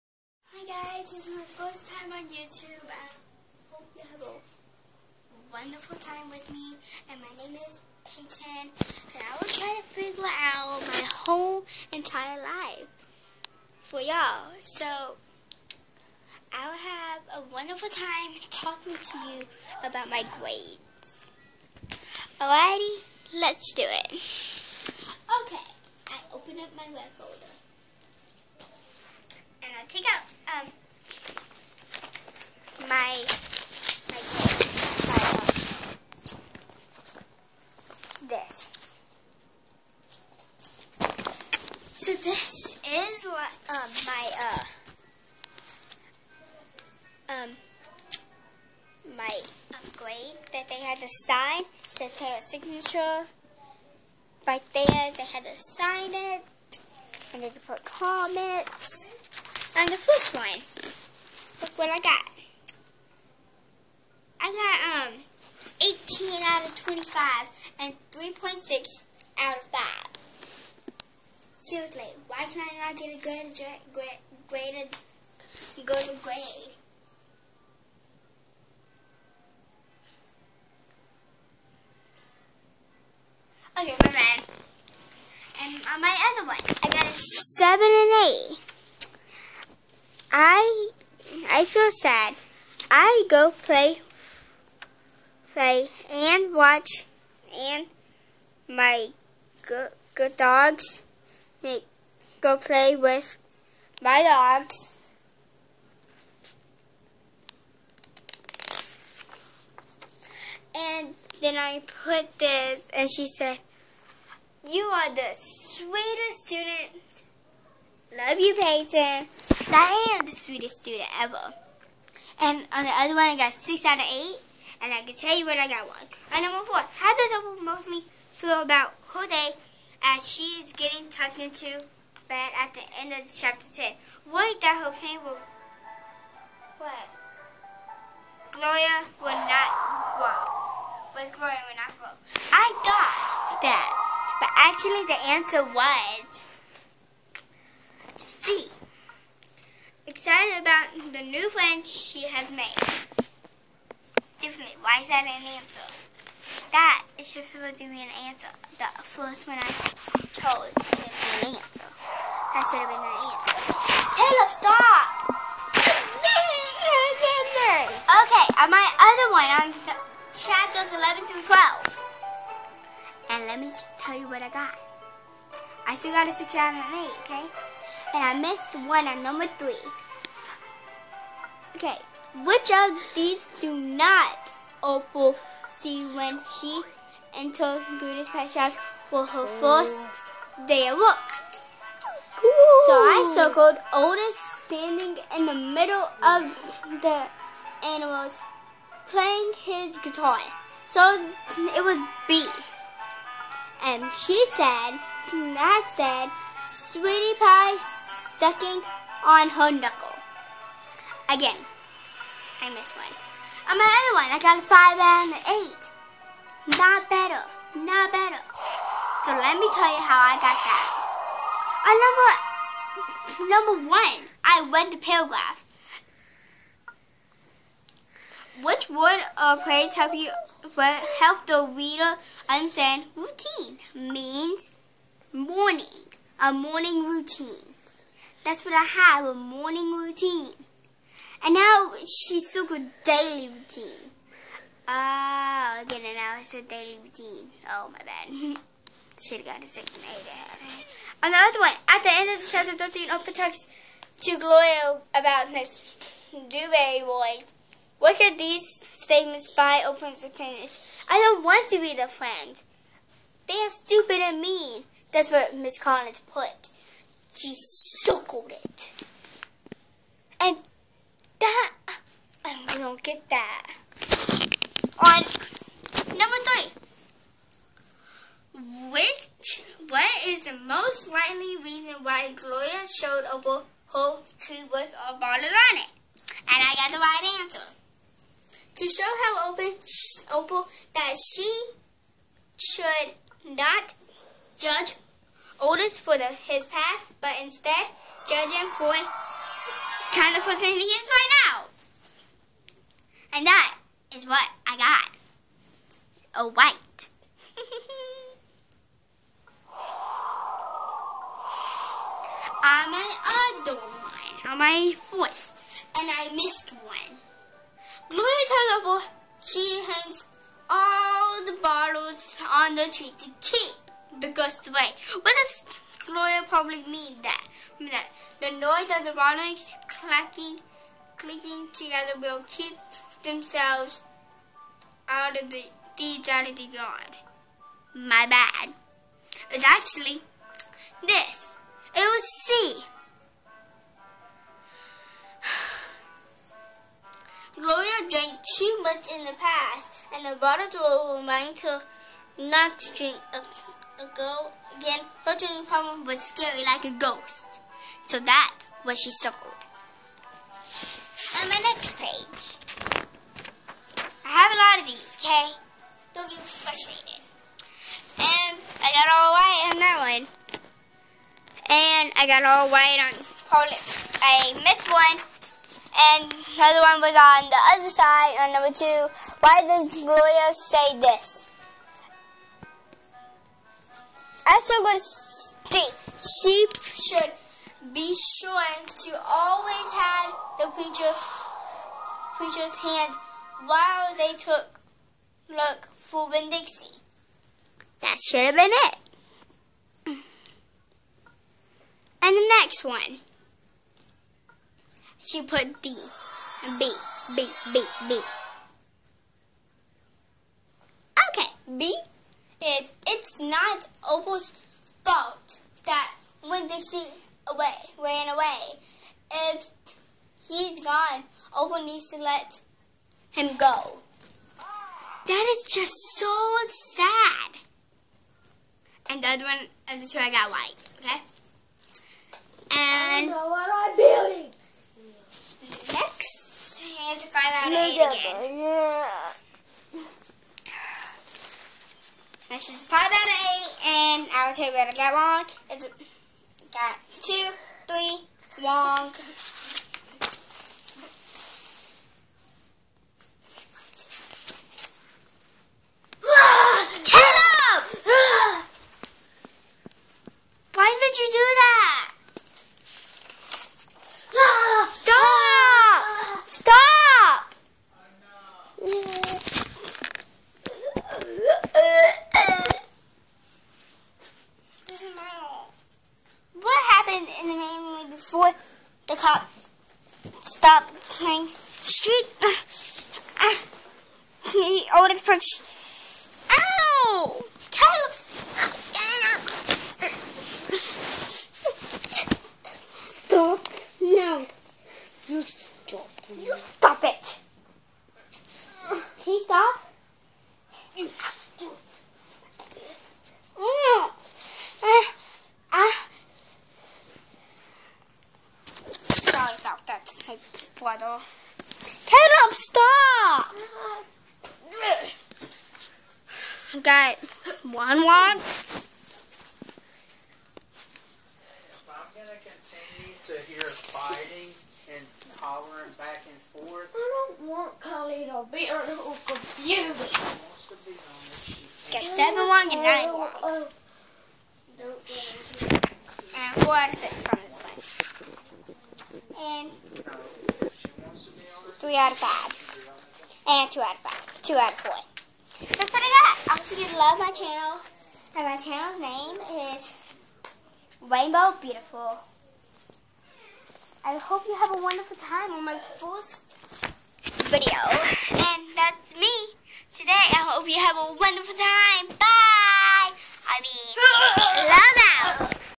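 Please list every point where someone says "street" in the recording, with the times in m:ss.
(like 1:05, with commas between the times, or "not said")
8:01.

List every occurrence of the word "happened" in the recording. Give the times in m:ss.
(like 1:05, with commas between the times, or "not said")
7:56.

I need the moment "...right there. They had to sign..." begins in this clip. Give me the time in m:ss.
0:54.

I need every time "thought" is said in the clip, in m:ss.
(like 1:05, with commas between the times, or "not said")
2:22.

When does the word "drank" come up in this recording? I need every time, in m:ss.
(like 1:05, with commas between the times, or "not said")
5:48.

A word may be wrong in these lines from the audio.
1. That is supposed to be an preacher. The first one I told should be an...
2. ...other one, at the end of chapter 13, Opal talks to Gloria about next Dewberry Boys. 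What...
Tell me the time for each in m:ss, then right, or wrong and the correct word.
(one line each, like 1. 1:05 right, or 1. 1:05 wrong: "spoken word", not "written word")
1. 2:36 wrong: "answer", not "preacher"
2. 4:11 right.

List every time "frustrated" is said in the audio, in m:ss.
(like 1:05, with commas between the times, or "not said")
6:06.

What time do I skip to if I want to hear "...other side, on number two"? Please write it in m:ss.
6:17.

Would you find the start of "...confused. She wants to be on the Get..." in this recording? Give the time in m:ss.
8:48.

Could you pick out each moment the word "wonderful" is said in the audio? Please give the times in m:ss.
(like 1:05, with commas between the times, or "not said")
0:05, 0:17, 9:14, 9:21.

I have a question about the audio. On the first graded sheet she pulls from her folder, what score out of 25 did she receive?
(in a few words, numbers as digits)
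18.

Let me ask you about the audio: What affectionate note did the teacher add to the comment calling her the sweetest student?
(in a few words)
Love you, Peyton.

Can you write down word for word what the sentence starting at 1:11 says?
Seriously, why can I not get a good grade, good grade?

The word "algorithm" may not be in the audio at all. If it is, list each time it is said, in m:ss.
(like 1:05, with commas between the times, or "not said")
not said.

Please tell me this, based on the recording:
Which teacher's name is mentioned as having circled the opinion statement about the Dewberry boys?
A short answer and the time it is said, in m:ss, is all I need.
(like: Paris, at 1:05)
Miss Collins, at 4:25.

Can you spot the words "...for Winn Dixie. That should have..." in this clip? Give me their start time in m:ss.
6:35.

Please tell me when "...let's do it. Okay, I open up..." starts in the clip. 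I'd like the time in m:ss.
0:23.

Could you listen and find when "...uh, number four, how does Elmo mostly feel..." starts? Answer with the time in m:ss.
2:06.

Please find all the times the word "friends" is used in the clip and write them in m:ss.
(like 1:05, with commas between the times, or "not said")
2:31, 4:22.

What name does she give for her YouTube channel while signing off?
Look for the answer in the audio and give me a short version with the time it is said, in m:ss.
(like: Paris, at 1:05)
Rainbow Beautiful, at 9:11.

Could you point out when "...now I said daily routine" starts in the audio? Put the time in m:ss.
4:06.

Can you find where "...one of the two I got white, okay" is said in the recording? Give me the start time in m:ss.
7:09.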